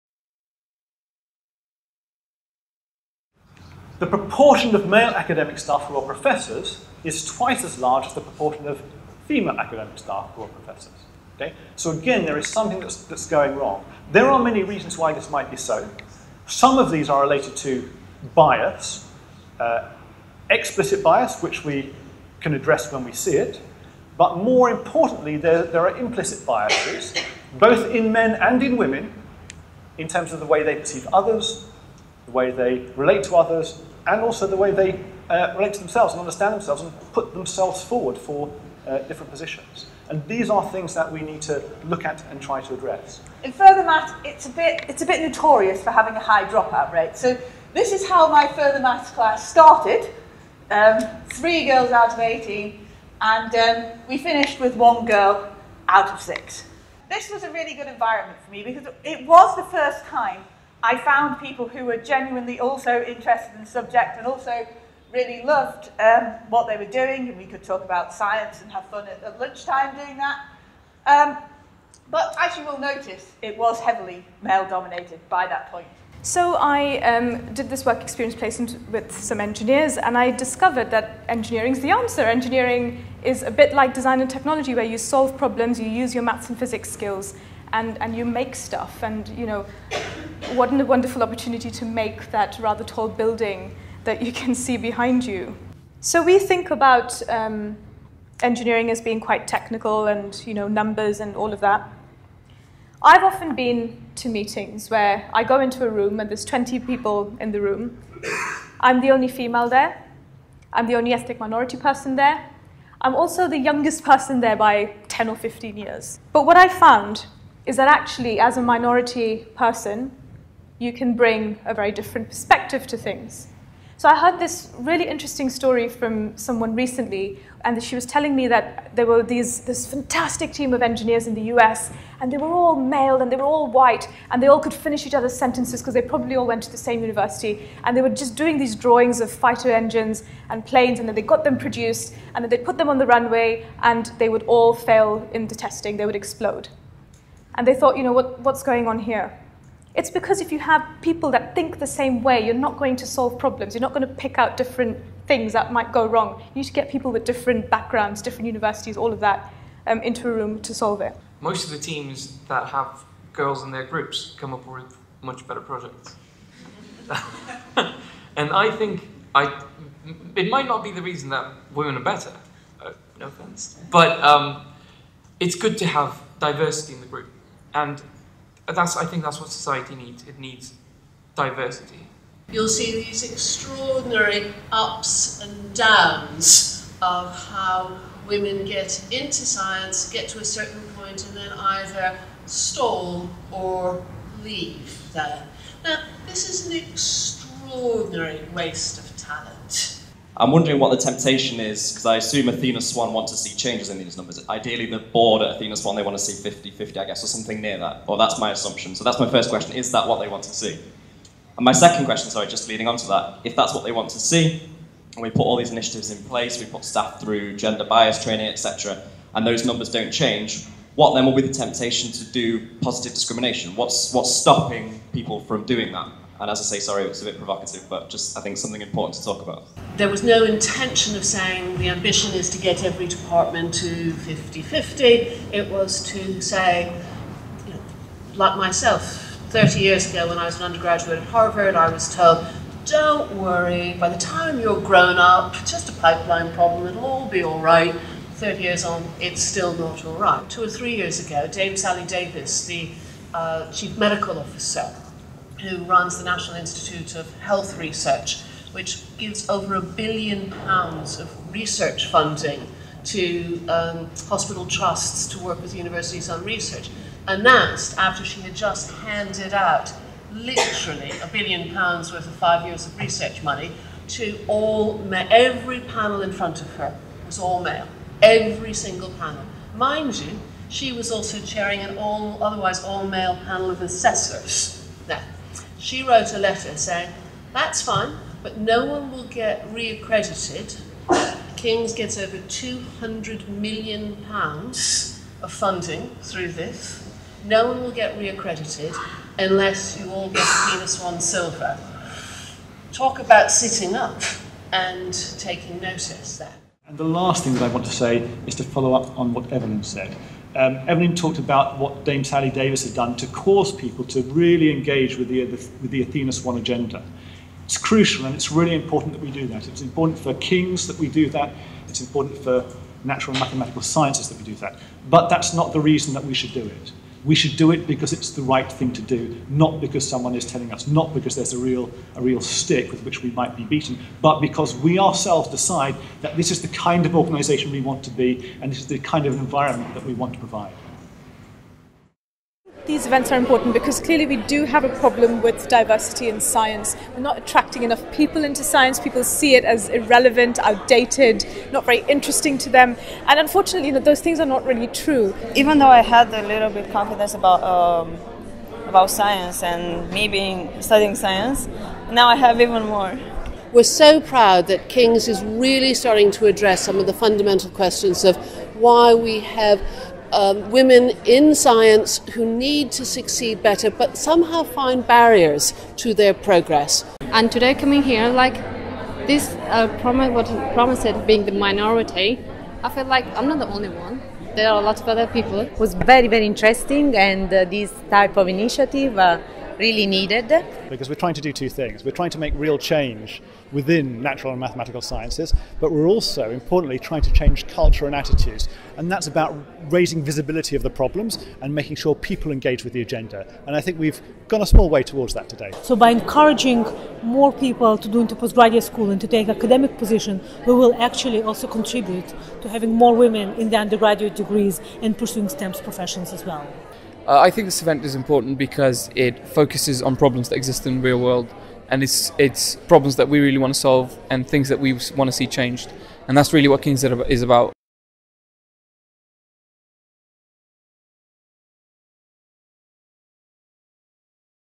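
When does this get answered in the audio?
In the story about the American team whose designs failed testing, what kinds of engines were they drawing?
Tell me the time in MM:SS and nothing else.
02:19.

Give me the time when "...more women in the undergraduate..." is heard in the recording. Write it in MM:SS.
06:53.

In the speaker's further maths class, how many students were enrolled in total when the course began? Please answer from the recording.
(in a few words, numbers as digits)
18.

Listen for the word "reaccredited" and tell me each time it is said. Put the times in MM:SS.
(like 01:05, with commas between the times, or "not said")
04:49, 04:58.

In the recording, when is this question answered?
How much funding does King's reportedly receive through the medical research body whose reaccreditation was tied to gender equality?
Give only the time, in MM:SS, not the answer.
04:52.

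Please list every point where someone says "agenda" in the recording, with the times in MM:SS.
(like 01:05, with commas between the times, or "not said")
05:16, 06:43.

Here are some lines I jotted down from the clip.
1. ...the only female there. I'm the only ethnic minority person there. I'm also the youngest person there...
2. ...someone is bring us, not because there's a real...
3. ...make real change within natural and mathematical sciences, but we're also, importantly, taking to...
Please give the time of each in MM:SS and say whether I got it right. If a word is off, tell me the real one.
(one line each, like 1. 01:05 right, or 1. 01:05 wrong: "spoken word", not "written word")
1. 01:49 right
2. 05:30 wrong: "telling", not "bring"
3. 06:32 wrong: "trying", not "taking".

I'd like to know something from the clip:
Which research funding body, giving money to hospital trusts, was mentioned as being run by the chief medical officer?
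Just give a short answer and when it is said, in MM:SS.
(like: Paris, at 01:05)
National Institute of Health Research, at 04:16.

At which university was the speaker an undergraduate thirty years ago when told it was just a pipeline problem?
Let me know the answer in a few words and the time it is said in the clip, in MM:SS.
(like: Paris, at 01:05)
Harvard, at 04:01.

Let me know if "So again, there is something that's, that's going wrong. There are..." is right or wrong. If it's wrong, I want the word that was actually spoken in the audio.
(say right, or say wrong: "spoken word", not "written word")
right.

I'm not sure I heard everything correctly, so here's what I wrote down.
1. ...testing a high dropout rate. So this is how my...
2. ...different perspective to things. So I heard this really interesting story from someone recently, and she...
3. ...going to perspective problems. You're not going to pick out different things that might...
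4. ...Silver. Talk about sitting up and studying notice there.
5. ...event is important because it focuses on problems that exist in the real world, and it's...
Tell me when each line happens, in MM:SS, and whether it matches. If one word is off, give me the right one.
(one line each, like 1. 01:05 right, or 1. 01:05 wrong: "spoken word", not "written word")
1. 00:45 wrong: "having", not "testing"
2. 02:01 right
3. 02:32 wrong: "solve", not "perspective"
4. 05:01 wrong: "taking", not "studying"
5. 06:57 right.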